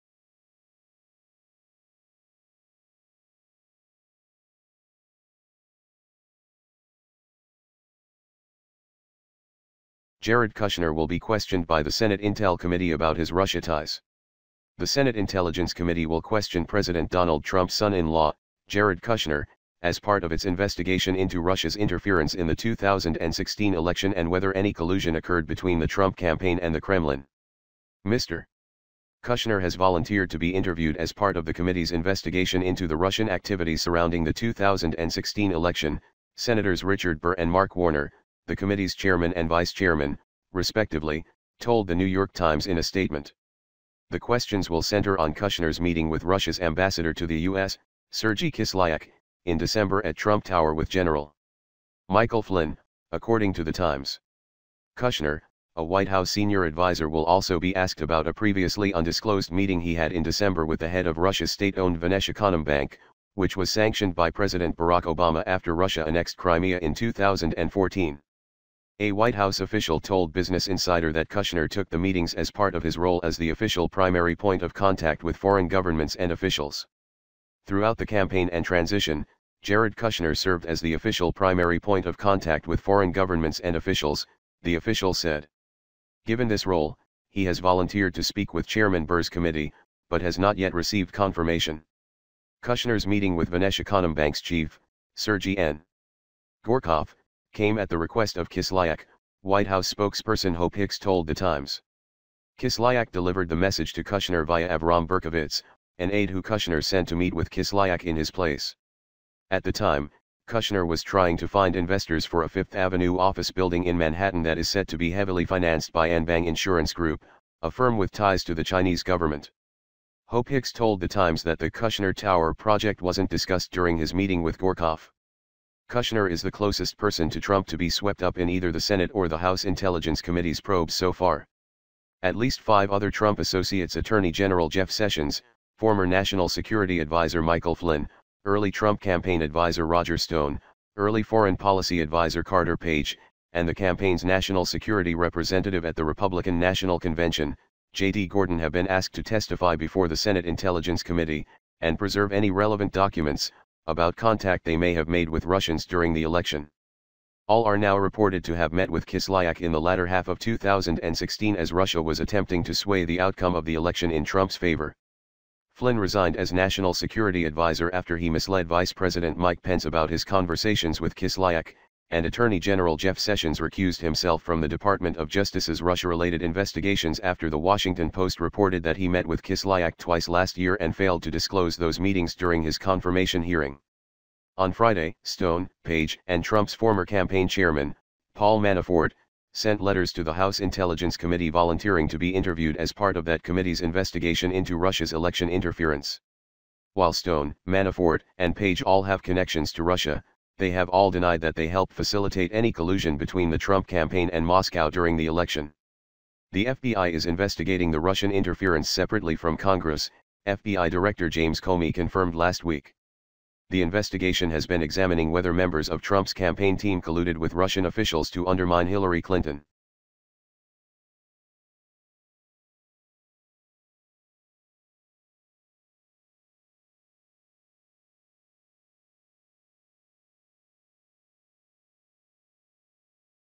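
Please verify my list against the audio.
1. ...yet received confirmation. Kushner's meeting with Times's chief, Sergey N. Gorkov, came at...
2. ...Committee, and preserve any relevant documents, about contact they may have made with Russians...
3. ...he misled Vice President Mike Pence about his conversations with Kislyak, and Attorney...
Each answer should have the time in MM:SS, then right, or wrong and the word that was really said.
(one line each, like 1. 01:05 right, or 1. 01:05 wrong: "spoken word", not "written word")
1. 01:30 wrong: "Vnesheconombank", not "Times"
2. 02:31 right
3. 02:48 right.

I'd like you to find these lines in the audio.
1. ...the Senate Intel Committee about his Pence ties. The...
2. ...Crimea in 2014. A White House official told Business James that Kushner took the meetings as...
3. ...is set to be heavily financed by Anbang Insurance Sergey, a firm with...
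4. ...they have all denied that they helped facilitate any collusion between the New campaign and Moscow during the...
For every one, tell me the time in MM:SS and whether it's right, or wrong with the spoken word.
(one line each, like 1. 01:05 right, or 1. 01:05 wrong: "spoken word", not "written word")
1. 00:11 wrong: "Russia", not "Pence"
2. 01:06 wrong: "Insider", not "James"
3. 01:54 wrong: "Group", not "Sergey"
4. 03:20 wrong: "Trump", not "New".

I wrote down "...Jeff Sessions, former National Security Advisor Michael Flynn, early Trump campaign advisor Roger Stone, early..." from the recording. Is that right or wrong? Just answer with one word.
right.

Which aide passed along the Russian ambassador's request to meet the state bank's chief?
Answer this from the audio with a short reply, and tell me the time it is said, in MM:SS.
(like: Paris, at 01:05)
Avrahm Berkowitz, at 01:44.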